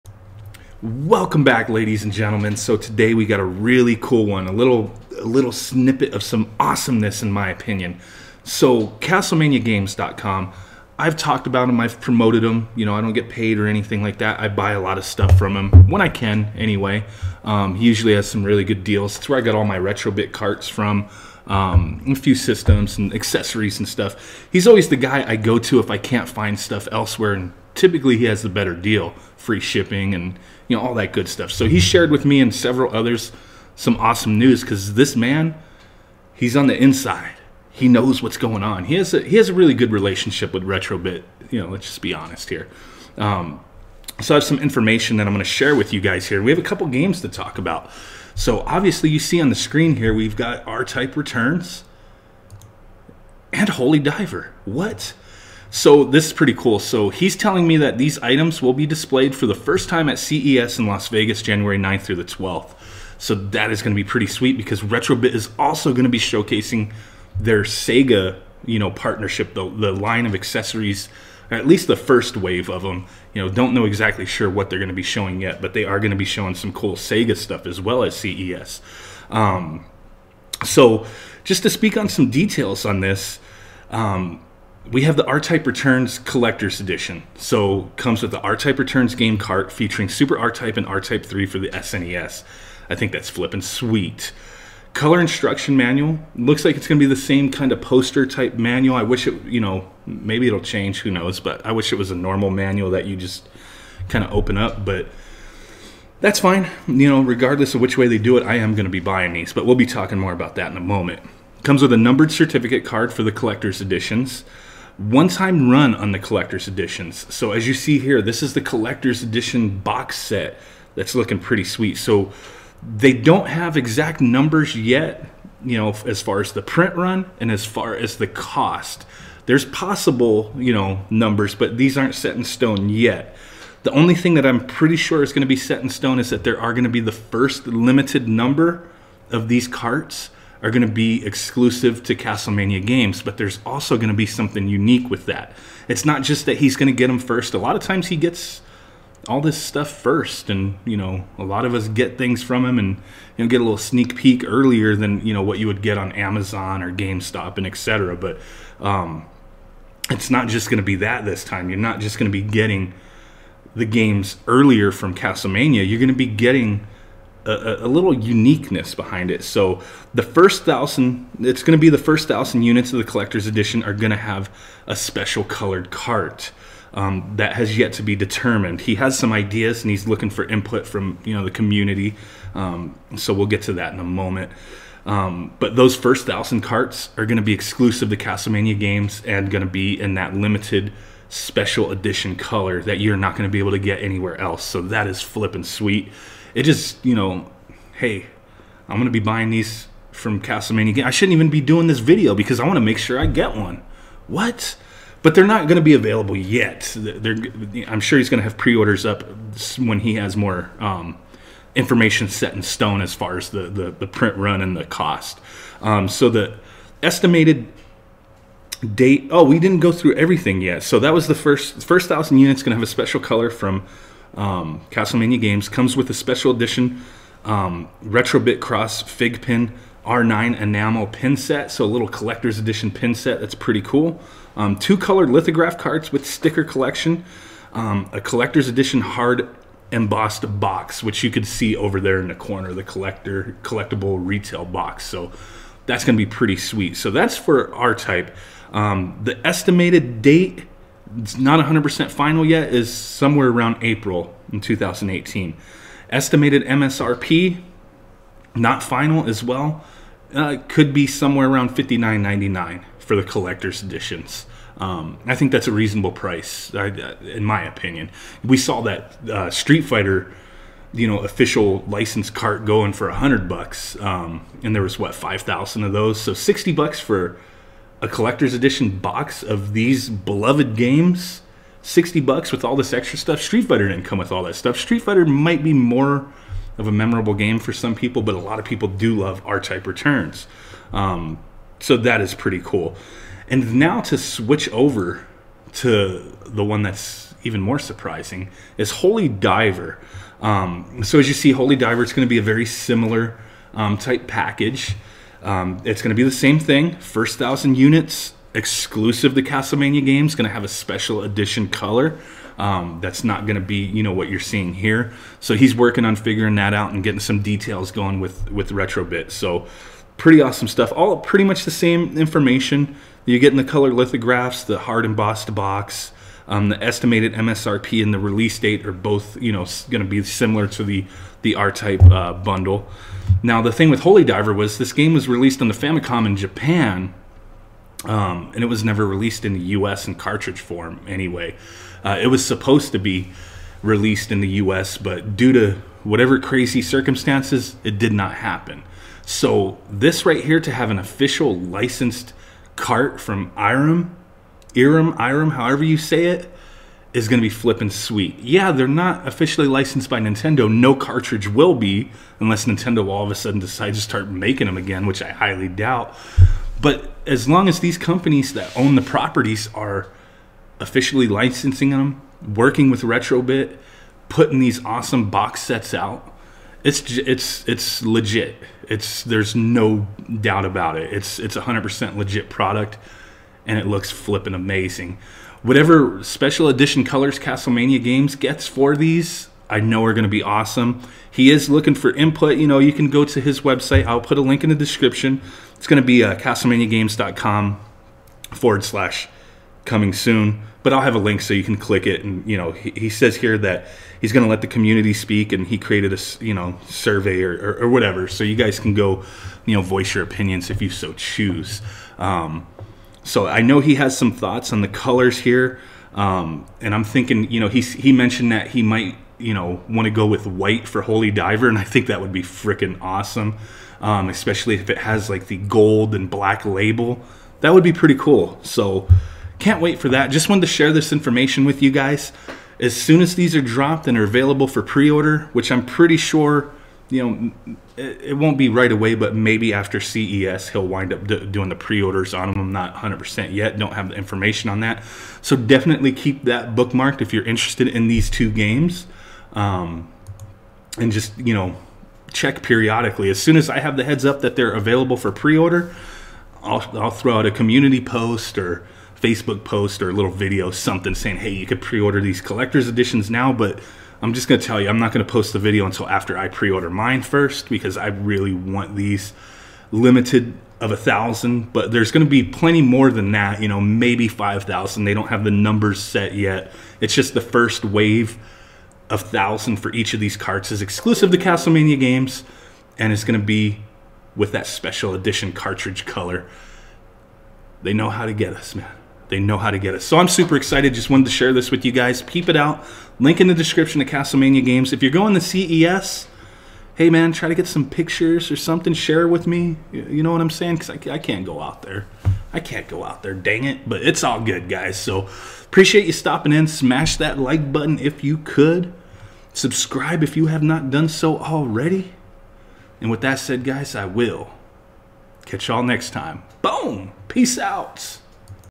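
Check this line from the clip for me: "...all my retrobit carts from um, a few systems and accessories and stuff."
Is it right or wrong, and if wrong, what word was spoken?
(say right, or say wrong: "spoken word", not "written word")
right.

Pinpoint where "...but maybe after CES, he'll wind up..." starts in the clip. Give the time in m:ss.
7:19.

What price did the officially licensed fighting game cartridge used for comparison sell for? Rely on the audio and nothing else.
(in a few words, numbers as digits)
$100.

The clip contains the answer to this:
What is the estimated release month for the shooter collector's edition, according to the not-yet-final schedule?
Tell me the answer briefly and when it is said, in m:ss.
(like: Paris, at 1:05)
April, at 4:13.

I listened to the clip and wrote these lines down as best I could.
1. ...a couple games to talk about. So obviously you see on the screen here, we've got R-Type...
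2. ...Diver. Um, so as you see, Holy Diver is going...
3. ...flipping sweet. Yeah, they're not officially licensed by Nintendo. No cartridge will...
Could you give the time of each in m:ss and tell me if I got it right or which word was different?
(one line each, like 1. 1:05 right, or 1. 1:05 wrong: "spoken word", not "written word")
1. 0:46 right
2. 4:59 right
3. 5:57 right.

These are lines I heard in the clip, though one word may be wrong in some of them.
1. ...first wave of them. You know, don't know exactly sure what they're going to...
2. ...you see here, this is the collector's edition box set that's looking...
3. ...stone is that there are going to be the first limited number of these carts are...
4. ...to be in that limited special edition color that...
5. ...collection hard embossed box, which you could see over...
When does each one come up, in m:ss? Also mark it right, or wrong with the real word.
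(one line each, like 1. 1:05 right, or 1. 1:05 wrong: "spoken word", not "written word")
1. 1:11 right
2. 1:57 right
3. 2:15 right
4. 3:09 right
5. 3:58 wrong: "edition", not "collection".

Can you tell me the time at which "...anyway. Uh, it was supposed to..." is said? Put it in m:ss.
5:41.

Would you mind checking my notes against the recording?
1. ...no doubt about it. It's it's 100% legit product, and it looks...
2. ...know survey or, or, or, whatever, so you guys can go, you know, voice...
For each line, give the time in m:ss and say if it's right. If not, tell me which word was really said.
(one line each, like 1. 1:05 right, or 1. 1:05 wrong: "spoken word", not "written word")
1. 6:19 right
2. 6:46 right.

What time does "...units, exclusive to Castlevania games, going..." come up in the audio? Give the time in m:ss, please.
5:07.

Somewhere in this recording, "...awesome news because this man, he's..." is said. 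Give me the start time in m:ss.
0:33.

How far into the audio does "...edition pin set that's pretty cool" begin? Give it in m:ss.
3:52.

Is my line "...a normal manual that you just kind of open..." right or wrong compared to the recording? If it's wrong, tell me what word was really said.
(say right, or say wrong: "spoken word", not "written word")
right.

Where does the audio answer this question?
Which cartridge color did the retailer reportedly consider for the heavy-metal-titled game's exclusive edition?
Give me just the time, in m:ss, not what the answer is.
7:00.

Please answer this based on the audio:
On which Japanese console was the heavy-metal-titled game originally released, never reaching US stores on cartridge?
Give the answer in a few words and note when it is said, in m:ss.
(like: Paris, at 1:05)
Famicom, at 5:35.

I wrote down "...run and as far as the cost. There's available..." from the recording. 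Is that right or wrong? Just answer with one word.
wrong.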